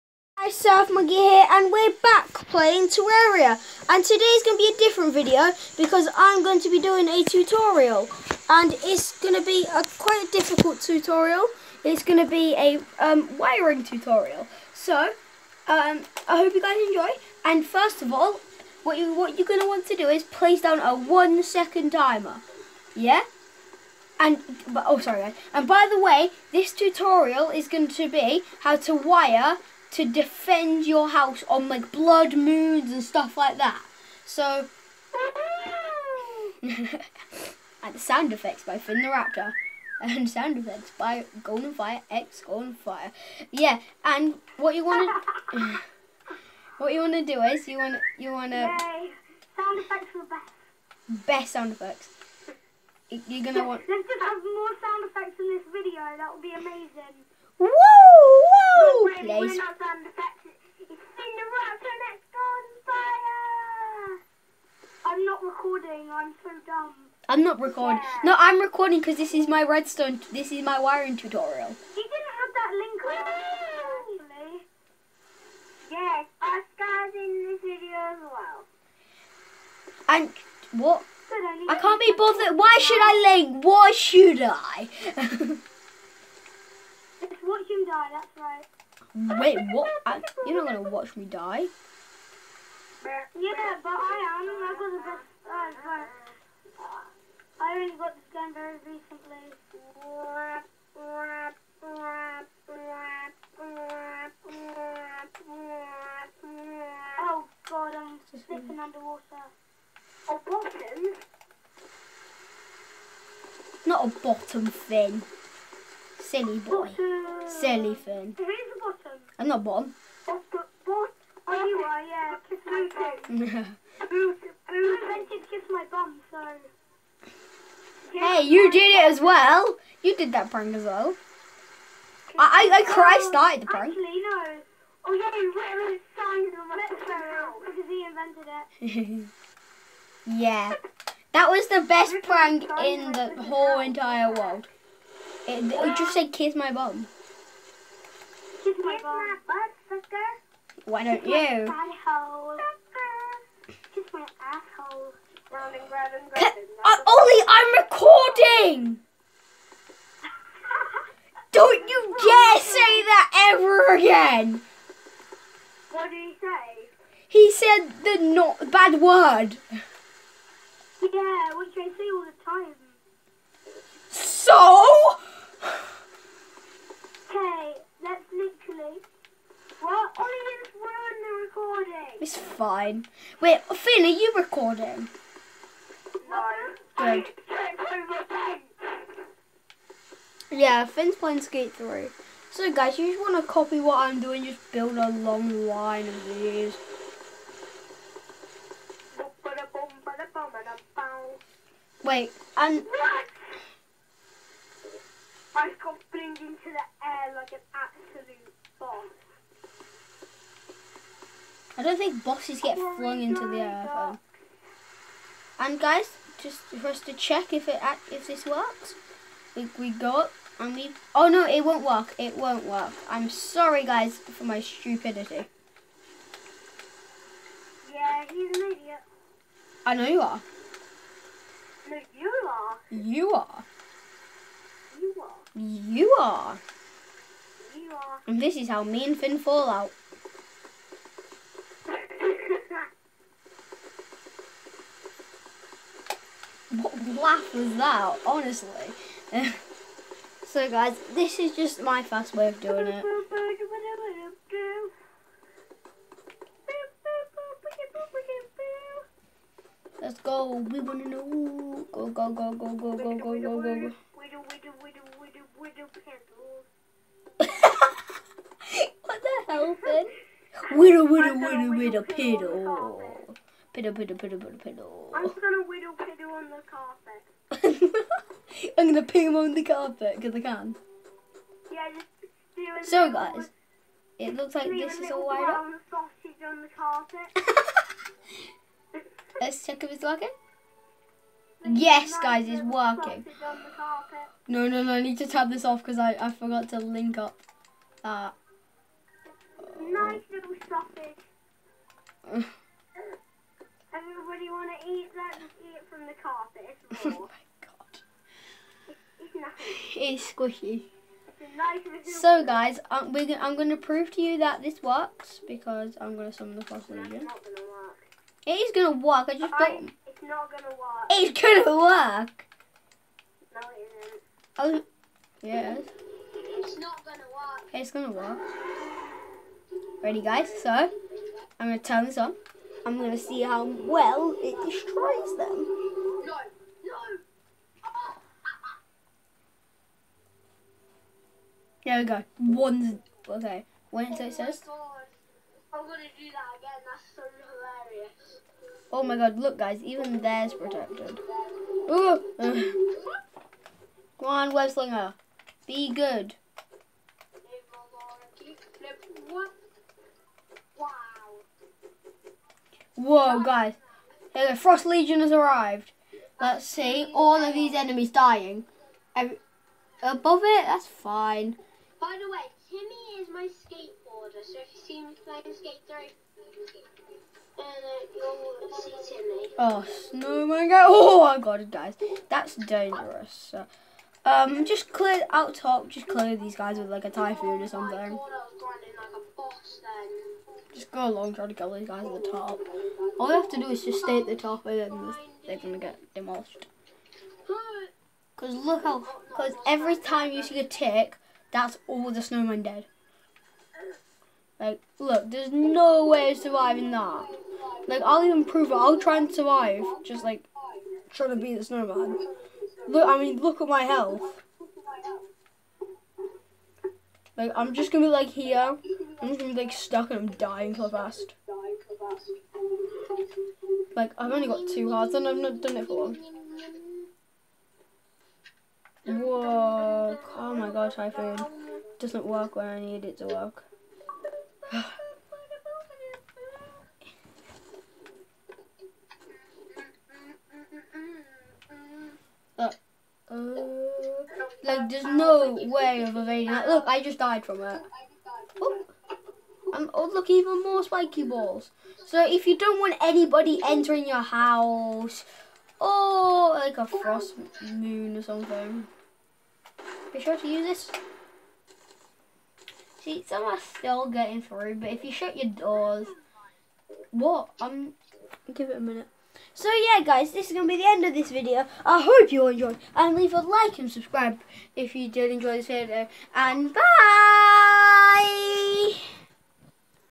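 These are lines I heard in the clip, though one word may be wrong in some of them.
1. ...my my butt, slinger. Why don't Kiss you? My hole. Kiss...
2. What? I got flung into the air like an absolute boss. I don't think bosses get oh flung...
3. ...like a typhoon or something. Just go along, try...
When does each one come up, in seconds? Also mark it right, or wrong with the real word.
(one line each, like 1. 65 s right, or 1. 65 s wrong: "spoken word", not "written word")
1. 148 s wrong: "sucker", not "slinger"
2. 202 s right
3. 386 s right.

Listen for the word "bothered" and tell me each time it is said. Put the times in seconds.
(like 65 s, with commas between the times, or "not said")
82 s.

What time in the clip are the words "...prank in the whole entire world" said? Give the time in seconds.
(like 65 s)
142 s.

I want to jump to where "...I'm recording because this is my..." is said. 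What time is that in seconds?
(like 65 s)
68 s.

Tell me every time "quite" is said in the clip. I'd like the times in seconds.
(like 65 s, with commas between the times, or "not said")
9 s.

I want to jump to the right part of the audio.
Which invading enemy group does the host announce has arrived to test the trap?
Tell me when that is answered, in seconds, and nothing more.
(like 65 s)
364 s.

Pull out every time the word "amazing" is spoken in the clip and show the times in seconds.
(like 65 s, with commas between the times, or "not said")
56 s.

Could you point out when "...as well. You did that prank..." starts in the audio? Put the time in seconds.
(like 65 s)
129 s.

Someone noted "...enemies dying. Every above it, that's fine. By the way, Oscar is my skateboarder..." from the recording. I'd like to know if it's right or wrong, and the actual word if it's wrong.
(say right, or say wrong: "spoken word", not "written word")
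wrong: "Timmy", not "Oscar".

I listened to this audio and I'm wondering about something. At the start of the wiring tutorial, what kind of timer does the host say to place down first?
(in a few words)
one second timer.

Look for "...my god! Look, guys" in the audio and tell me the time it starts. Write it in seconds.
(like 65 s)
349 s.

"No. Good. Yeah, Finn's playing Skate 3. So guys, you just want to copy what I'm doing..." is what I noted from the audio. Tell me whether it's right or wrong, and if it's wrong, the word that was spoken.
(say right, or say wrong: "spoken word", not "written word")
right.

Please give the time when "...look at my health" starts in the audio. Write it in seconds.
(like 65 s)
413 s.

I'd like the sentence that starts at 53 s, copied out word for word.
Let's just have more sound effects in this video.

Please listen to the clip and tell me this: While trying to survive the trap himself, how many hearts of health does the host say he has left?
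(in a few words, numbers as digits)
2.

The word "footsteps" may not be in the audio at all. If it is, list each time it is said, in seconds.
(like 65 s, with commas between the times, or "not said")
not said.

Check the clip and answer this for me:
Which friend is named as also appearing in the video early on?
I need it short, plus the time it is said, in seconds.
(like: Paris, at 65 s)
Oscar, at 76 s.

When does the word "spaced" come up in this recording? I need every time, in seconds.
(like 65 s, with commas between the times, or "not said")
not said.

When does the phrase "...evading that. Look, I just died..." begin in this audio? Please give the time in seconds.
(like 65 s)
446 s.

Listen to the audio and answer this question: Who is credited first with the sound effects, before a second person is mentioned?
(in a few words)
Finn the Raptor.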